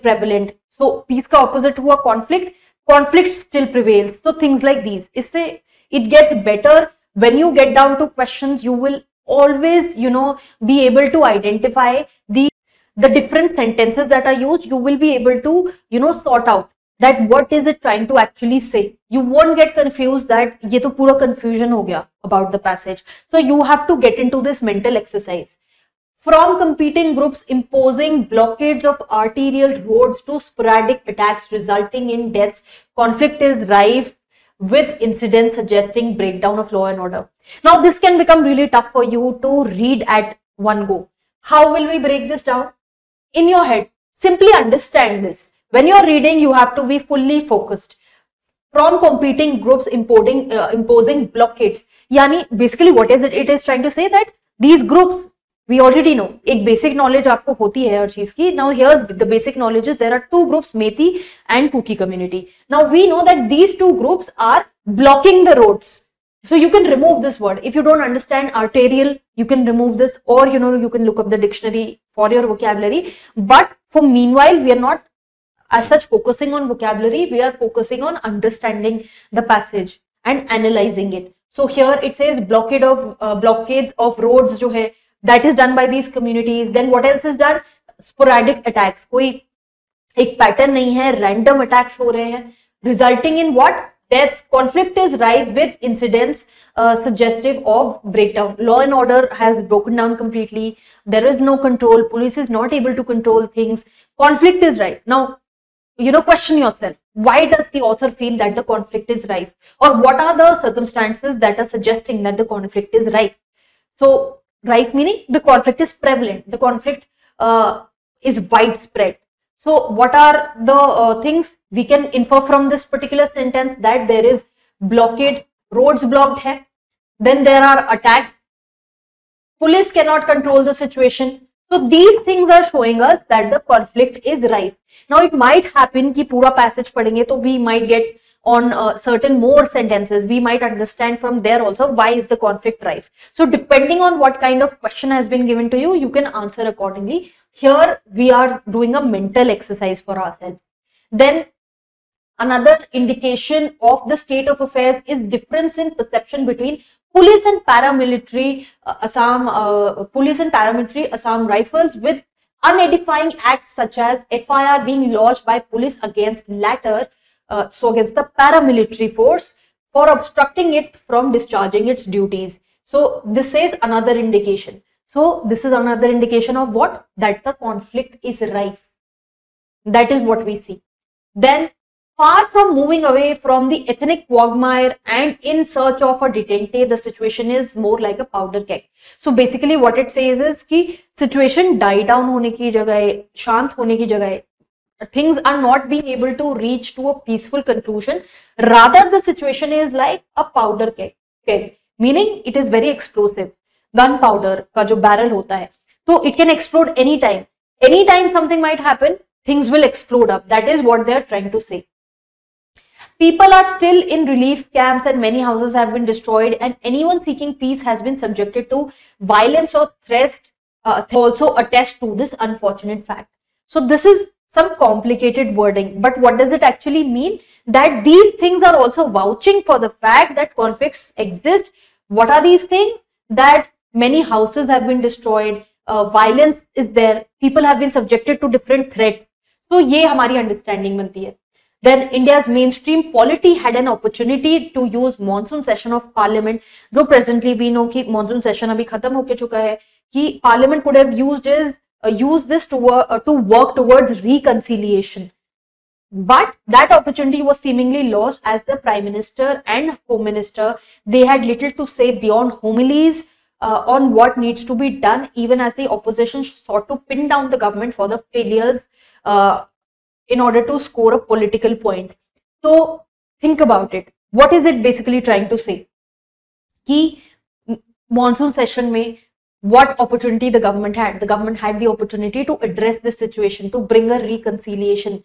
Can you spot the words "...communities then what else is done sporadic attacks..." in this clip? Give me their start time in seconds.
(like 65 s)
86 s.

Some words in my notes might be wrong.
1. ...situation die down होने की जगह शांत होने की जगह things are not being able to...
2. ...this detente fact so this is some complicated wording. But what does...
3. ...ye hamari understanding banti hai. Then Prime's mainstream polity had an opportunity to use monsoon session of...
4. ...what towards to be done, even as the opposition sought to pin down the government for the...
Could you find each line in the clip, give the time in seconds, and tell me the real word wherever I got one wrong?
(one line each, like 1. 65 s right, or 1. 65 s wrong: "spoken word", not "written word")
1. 191 s right
2. 222 s wrong: "unfortunate", not "detente"
3. 239 s wrong: "India", not "Prime"
4. 264 s wrong: "needs", not "towards".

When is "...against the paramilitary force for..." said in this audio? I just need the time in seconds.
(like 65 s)
167 s.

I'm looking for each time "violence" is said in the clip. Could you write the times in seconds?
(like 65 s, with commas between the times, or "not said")
219 s, 236 s.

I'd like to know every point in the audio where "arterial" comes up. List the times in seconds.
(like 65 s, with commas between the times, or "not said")
29 s, 68 s.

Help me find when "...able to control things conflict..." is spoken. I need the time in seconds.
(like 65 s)
102 s.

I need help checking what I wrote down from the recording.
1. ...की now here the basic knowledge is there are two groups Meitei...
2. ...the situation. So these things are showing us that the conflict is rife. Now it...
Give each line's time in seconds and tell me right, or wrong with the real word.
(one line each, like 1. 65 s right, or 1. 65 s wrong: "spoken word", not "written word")
1. 58 s right
2. 130 s right.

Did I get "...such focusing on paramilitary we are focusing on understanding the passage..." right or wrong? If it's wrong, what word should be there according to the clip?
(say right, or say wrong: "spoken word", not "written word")
wrong: "vocabulary", not "paramilitary".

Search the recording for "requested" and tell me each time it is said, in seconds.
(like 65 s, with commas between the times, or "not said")
not said.